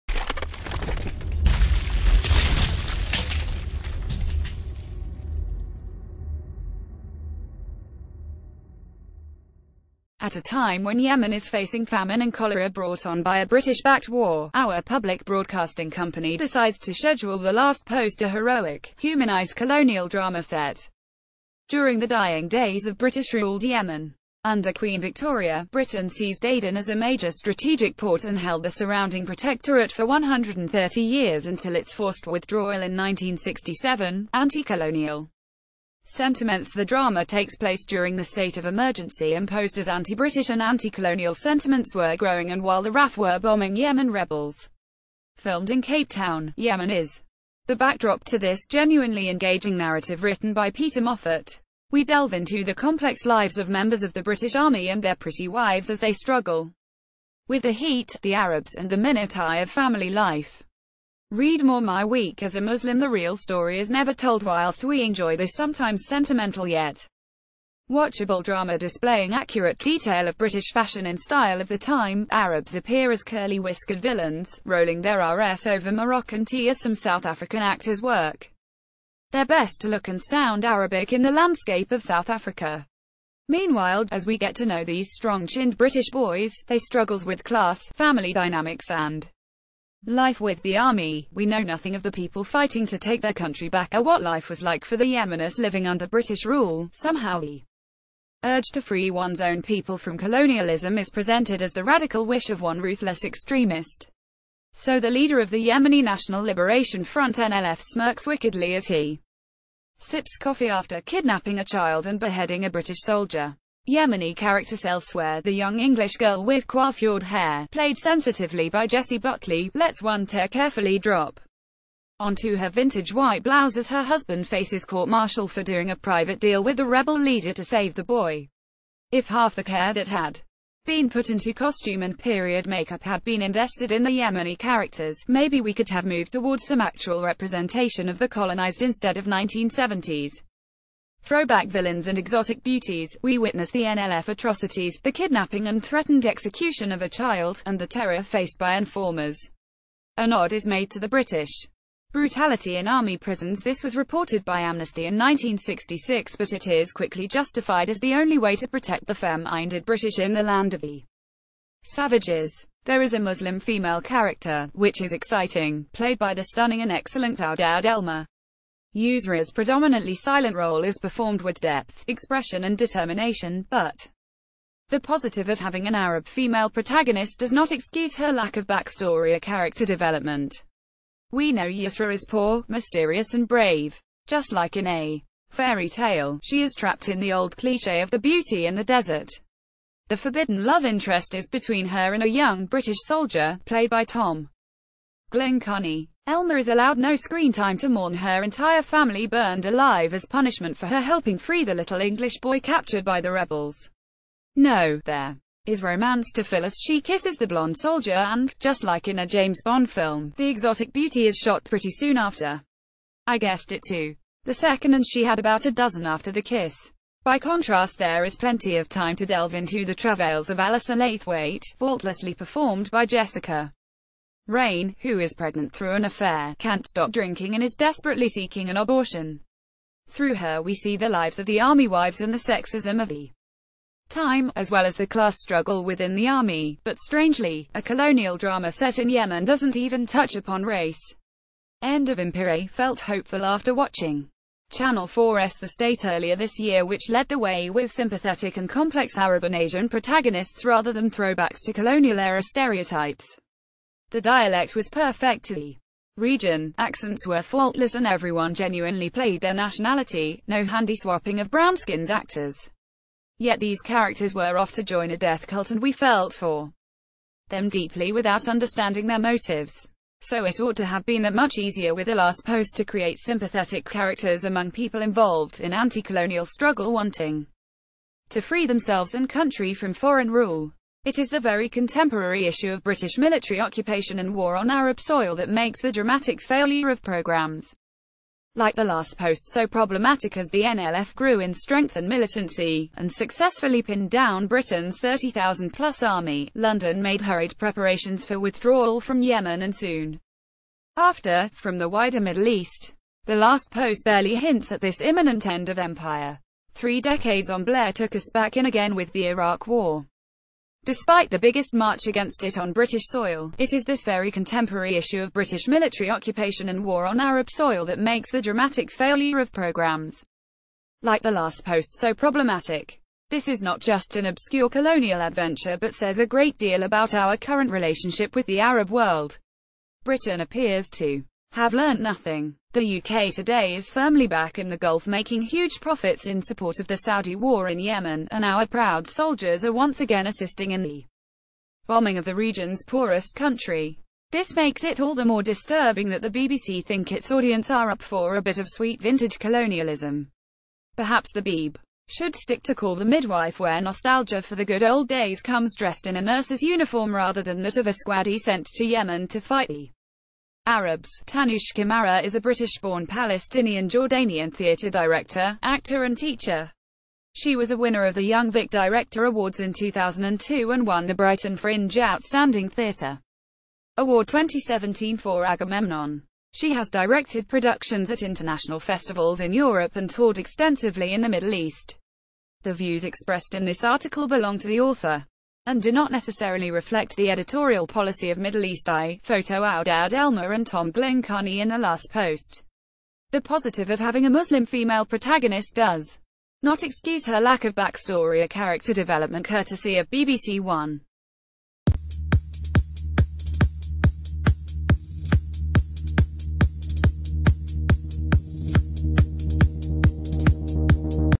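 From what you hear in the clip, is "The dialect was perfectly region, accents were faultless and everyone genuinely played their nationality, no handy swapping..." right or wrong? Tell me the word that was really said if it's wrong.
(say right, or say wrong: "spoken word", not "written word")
right.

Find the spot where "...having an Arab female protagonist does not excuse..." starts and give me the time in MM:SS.
02:55.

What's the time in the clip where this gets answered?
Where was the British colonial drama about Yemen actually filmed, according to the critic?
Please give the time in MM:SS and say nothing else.
00:45.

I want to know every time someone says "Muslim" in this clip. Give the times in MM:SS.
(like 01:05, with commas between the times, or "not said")
01:02, 02:43, 06:34.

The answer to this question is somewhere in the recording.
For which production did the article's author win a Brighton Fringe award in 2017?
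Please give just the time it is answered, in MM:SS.
06:15.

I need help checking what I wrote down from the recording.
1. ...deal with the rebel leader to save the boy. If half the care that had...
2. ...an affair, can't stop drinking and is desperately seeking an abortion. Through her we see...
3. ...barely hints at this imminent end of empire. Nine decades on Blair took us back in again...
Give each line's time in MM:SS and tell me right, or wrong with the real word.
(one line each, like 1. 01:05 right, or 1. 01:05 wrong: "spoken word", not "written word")
1. 02:06 right
2. 03:45 right
3. 05:04 wrong: "Three", not "Nine".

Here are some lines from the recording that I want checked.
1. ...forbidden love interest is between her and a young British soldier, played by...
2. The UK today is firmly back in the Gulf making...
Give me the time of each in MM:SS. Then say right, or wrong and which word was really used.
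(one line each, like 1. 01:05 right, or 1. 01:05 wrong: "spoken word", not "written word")
1. 03:10 right
2. 05:32 right.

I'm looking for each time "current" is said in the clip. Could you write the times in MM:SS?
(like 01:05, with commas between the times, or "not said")
05:27.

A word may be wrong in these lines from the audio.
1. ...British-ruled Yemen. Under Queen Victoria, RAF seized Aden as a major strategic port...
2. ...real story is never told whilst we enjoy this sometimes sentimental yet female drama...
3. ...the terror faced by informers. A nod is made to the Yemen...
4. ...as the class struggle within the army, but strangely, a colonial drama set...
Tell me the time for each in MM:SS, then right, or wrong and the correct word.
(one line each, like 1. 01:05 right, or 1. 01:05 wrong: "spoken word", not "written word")
1. 00:22 wrong: "Britain", not "RAF"
2. 01:03 wrong: "watchable", not "female"
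3. 02:27 wrong: "British", not "Yemen"
4. 03:54 right.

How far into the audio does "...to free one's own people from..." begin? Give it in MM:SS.
01:38.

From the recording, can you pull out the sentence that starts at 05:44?
This makes it all the more disturbing that the BBC think its audience are up for a bit of sweet vintage colonialism.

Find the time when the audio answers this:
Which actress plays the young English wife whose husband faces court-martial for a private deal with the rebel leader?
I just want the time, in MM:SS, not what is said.
01:58.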